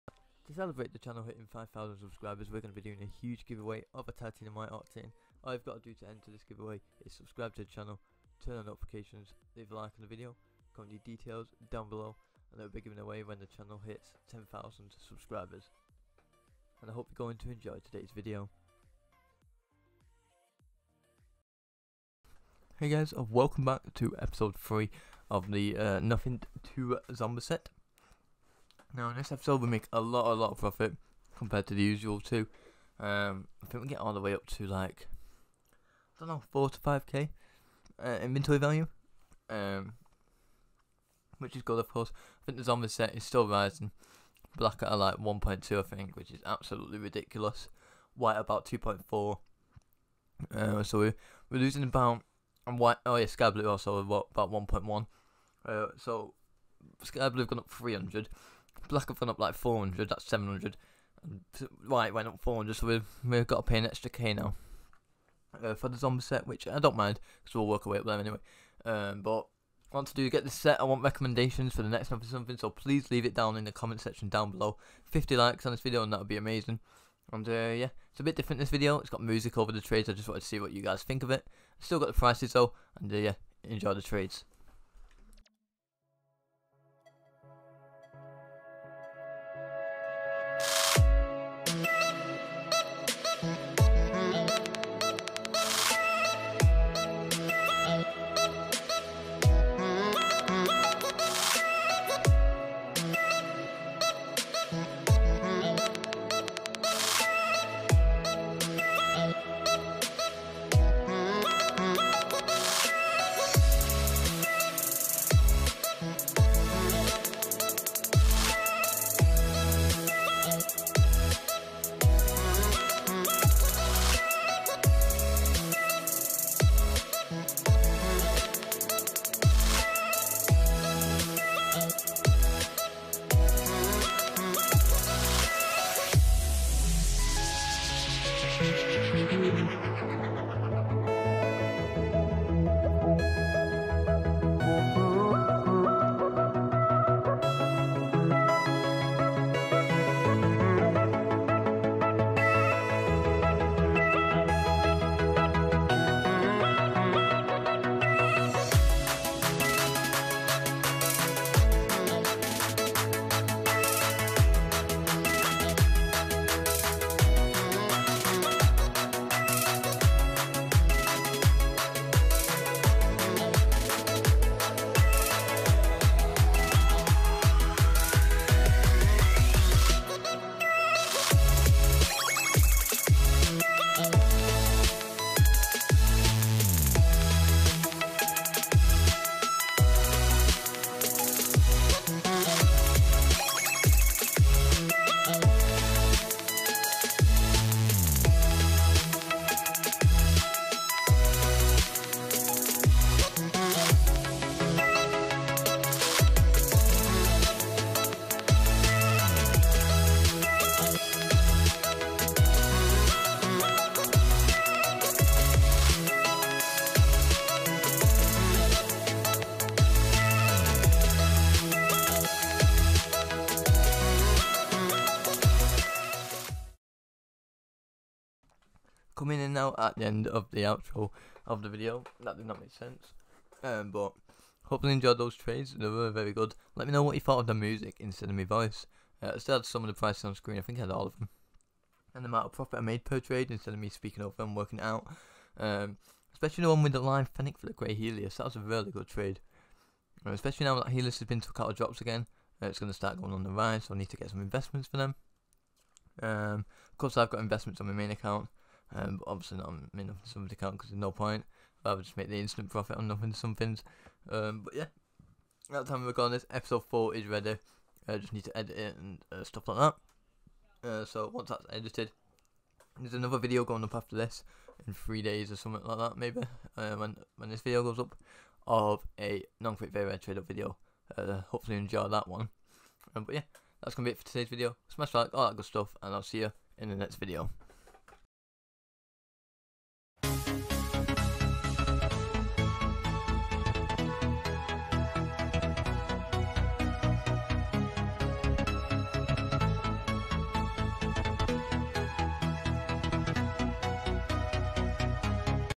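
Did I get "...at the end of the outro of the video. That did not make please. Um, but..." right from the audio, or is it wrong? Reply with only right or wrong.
wrong.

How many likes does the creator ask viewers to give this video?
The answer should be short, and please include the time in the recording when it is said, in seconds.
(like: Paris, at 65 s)
50, at 75 s.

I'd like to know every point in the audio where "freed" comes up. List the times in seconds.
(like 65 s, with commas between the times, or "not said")
not said.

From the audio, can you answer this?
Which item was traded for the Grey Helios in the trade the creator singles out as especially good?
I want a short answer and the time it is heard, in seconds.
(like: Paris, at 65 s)
Lime Fennec, at 246 s.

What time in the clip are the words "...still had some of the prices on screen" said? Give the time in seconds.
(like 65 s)
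239 s.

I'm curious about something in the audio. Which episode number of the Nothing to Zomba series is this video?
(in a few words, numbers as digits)
3.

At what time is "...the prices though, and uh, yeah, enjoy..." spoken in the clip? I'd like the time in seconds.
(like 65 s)
82 s.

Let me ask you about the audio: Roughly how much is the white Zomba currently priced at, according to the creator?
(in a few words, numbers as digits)
2.4.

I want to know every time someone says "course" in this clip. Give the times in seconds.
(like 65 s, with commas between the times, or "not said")
41 s, 256 s.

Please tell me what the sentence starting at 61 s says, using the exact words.
White went up 400, so we've, we've got to pay an extra K now.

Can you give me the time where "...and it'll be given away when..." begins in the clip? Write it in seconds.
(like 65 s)
12 s.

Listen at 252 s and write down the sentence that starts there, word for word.
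Uh, it's going to start going on the rise.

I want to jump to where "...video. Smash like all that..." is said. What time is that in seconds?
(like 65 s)
284 s.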